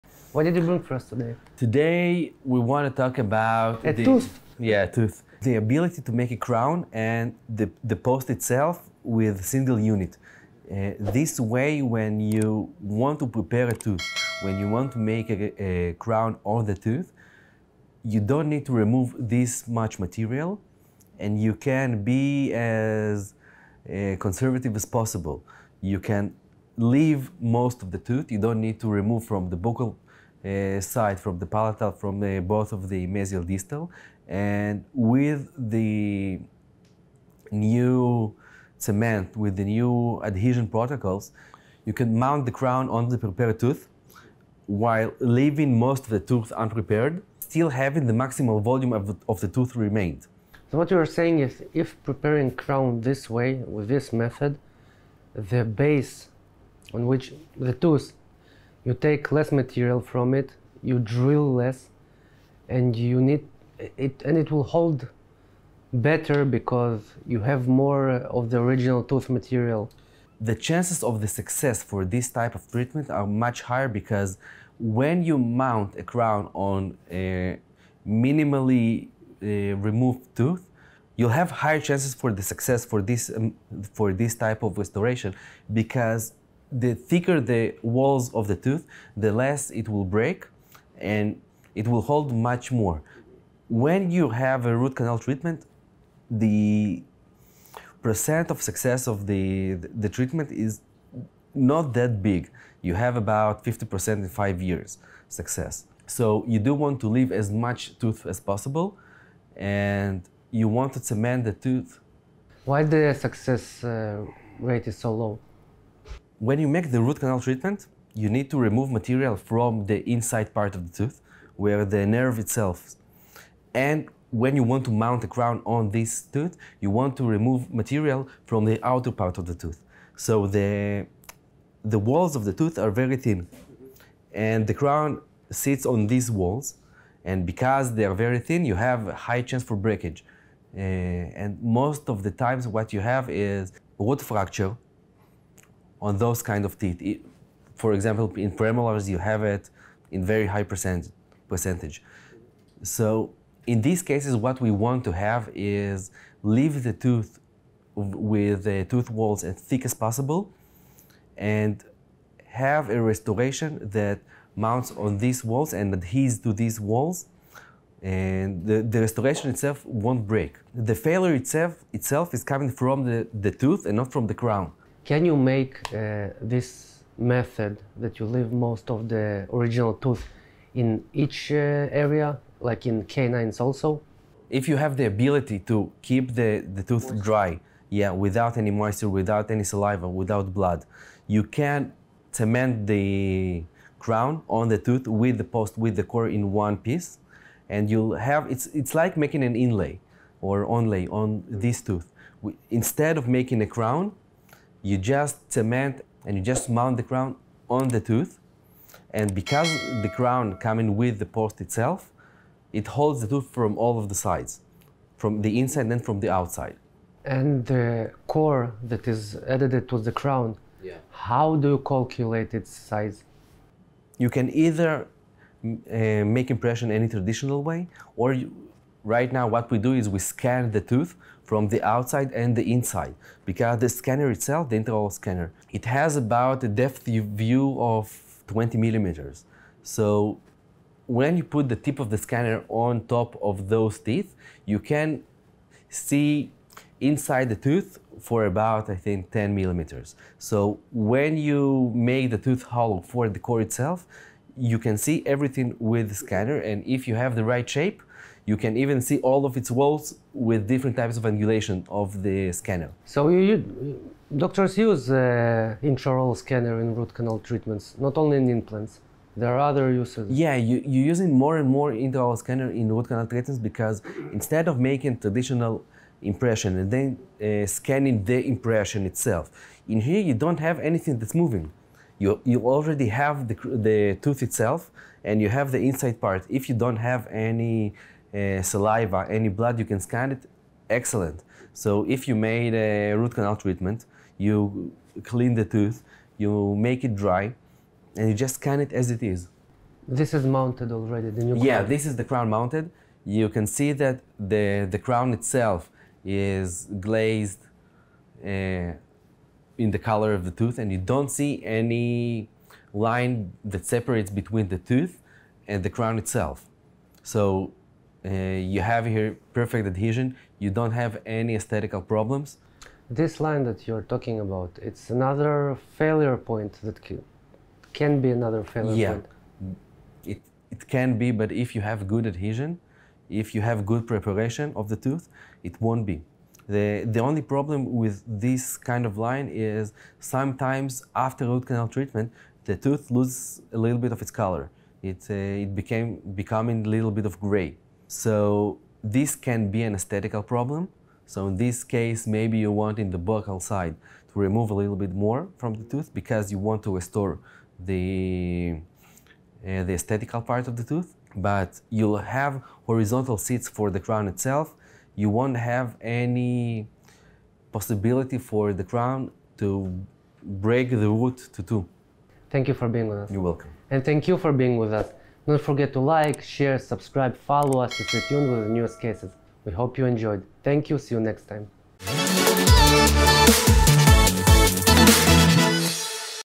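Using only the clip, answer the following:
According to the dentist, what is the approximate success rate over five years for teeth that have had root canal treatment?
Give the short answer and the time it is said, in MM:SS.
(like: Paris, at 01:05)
50%, at 01:43.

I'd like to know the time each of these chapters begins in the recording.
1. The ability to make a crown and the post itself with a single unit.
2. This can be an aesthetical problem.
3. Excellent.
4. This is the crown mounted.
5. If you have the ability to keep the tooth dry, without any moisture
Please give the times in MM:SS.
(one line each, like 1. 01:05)
1. 00:33
2. 05:57
3. 04:58
4. 05:30
5. 03:33.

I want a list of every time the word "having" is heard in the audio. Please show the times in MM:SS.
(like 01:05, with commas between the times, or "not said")
00:47.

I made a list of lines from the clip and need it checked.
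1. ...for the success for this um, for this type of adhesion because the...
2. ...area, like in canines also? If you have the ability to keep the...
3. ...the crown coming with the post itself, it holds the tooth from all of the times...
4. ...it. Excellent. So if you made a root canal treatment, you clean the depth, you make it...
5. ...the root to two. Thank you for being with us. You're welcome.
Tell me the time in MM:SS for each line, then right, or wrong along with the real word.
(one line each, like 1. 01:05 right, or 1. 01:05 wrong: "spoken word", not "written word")
1. 01:22 wrong: "restoration", not "adhesion"
2. 03:01 right
3. 03:30 wrong: "sides", not "times"
4. 04:50 wrong: "tooth", not "depth"
5. 06:10 right.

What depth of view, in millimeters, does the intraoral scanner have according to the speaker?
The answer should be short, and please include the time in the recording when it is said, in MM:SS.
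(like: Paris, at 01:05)
20 millimeters, at 03:58.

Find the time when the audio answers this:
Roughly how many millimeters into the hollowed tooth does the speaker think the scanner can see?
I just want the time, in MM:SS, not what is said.
04:09.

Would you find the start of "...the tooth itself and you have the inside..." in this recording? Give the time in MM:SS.
04:43.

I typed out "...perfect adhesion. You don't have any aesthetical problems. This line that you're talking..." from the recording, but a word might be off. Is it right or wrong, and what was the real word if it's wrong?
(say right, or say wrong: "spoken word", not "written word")
right.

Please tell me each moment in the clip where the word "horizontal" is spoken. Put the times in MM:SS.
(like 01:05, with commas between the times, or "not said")
06:02.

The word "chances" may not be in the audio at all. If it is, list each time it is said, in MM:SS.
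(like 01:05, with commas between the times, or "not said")
01:10, 01:21, 02:19.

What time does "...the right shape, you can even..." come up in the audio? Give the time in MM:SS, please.
04:17.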